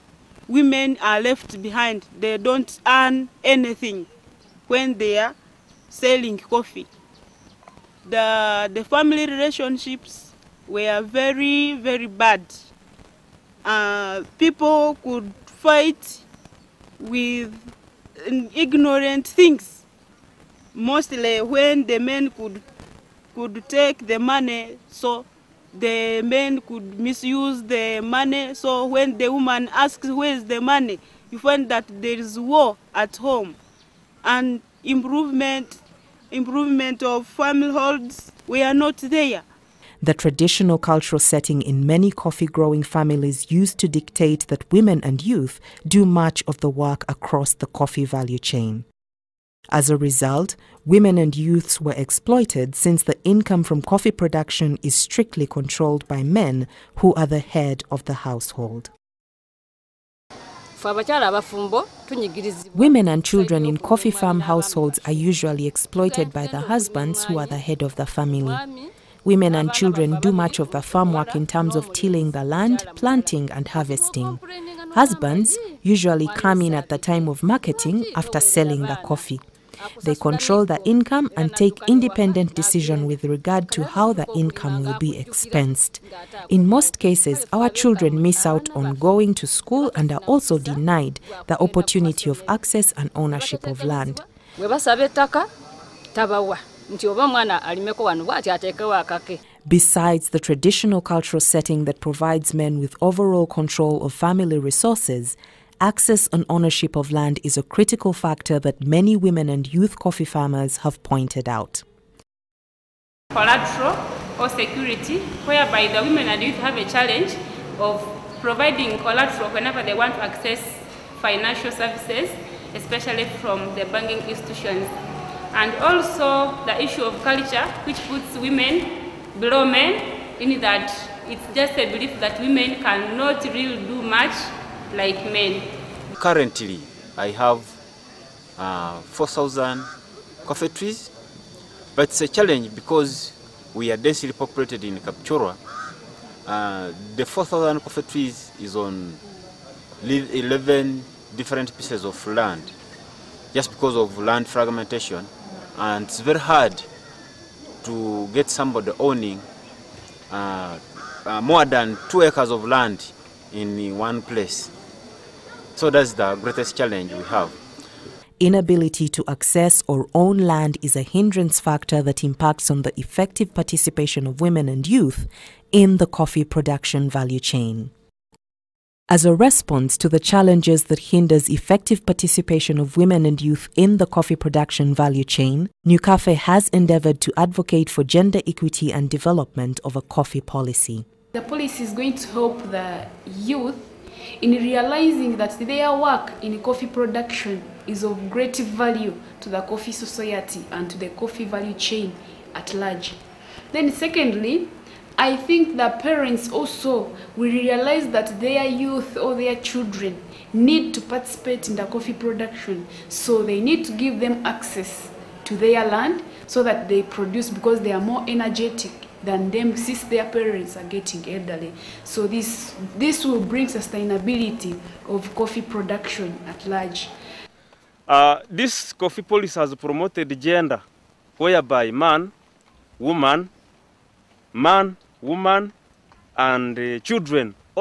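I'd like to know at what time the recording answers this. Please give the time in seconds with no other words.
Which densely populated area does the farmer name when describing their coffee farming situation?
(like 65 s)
144 s.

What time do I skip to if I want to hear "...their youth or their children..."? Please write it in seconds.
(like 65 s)
208 s.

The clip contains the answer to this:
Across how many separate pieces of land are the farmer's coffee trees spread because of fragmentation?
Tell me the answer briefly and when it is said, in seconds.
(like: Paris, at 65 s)
11, at 150 s.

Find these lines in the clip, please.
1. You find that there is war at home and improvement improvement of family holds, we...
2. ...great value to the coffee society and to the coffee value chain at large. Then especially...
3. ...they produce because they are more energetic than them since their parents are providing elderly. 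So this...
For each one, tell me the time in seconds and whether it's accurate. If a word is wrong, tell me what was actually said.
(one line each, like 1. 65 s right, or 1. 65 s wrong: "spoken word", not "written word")
1. 31 s right
2. 198 s wrong: "secondly", not "especially"
3. 216 s wrong: "getting", not "providing".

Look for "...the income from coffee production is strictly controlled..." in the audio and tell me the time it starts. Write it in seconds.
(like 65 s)
53 s.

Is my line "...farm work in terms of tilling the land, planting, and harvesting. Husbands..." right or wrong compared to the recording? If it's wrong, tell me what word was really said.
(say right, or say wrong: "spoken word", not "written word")
right.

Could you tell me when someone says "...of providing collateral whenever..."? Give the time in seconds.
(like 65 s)
117 s.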